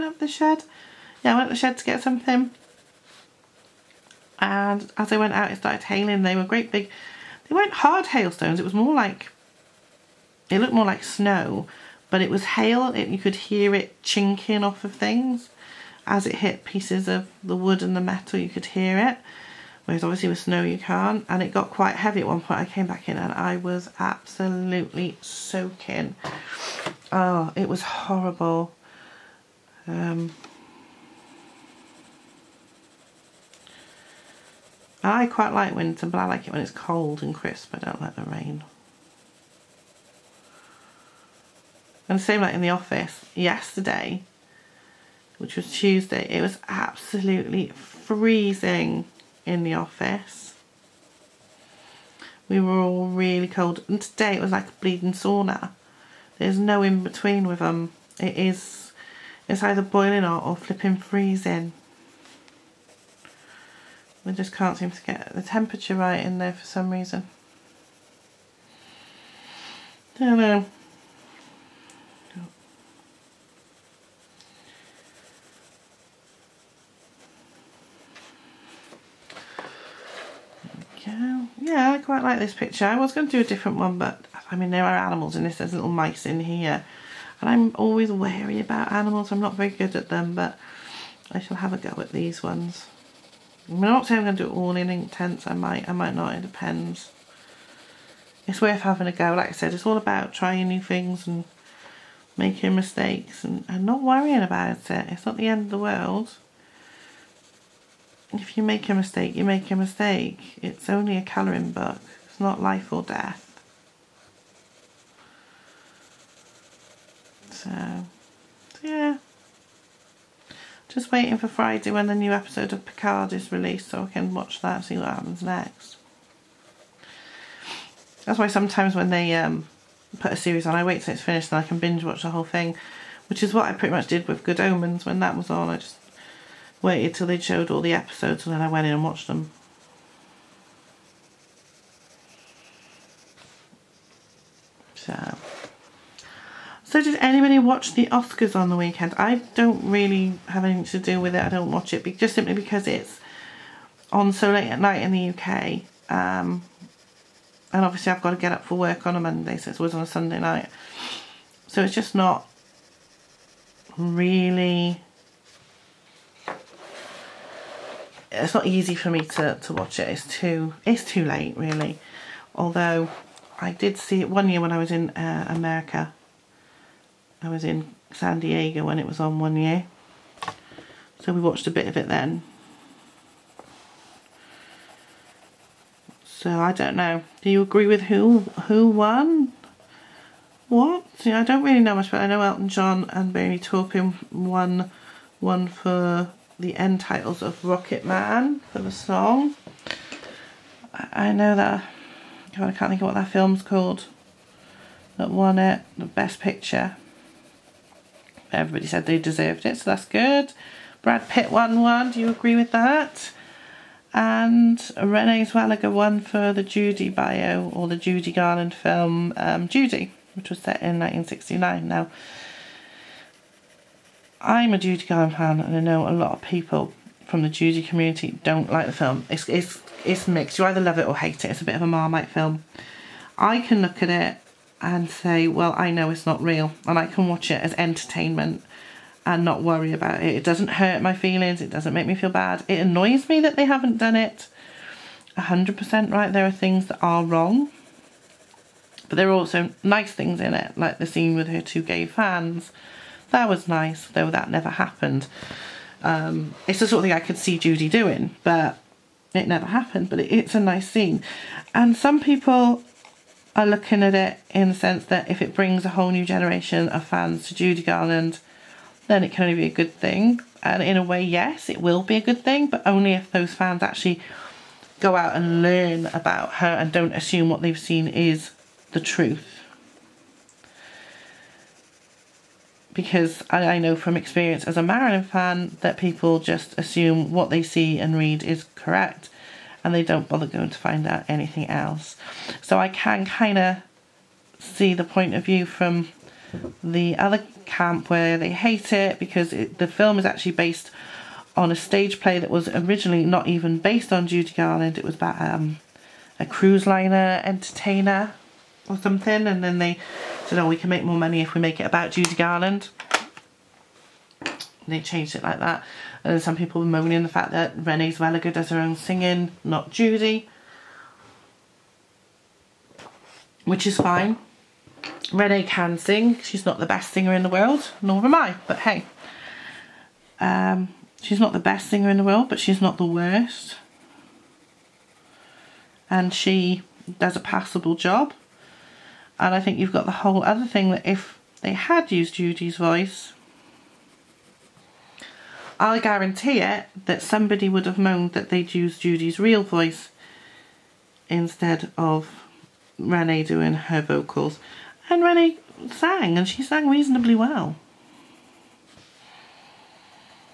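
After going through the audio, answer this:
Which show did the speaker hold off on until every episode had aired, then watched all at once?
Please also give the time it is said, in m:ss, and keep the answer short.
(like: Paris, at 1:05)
Good Omens, at 2:14.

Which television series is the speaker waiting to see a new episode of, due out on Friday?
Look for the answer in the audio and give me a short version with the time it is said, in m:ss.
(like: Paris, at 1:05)
Picard, at 2:02.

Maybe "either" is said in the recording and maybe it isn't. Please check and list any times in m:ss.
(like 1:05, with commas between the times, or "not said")
0:59, 3:50.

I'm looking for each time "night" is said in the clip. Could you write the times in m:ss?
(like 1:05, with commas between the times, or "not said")
2:34, 2:40.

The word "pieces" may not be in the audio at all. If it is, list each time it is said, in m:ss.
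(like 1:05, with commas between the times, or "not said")
0:16.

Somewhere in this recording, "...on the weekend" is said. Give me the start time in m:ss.
2:28.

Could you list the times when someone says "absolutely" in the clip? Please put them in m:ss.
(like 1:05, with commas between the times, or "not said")
0:23, 0:46.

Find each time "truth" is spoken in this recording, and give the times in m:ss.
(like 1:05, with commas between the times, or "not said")
4:39.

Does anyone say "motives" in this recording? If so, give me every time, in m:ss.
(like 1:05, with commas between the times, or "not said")
not said.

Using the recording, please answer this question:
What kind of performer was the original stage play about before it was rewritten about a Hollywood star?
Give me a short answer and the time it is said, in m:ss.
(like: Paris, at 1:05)
cruise liner entertainer, at 5:06.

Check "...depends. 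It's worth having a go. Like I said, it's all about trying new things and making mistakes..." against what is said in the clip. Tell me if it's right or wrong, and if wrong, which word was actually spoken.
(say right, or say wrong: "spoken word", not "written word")
right.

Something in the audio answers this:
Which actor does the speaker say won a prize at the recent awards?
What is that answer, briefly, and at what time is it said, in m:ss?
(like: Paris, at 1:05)
Brad Pitt, at 3:31.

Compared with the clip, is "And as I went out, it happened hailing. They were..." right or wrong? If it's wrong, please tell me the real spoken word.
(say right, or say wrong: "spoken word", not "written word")
wrong: "started", not "happened".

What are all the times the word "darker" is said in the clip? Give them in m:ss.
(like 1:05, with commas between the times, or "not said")
not said.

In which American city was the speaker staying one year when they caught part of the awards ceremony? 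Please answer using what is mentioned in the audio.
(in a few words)
San Diego.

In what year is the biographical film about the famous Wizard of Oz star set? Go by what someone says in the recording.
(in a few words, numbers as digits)
1969.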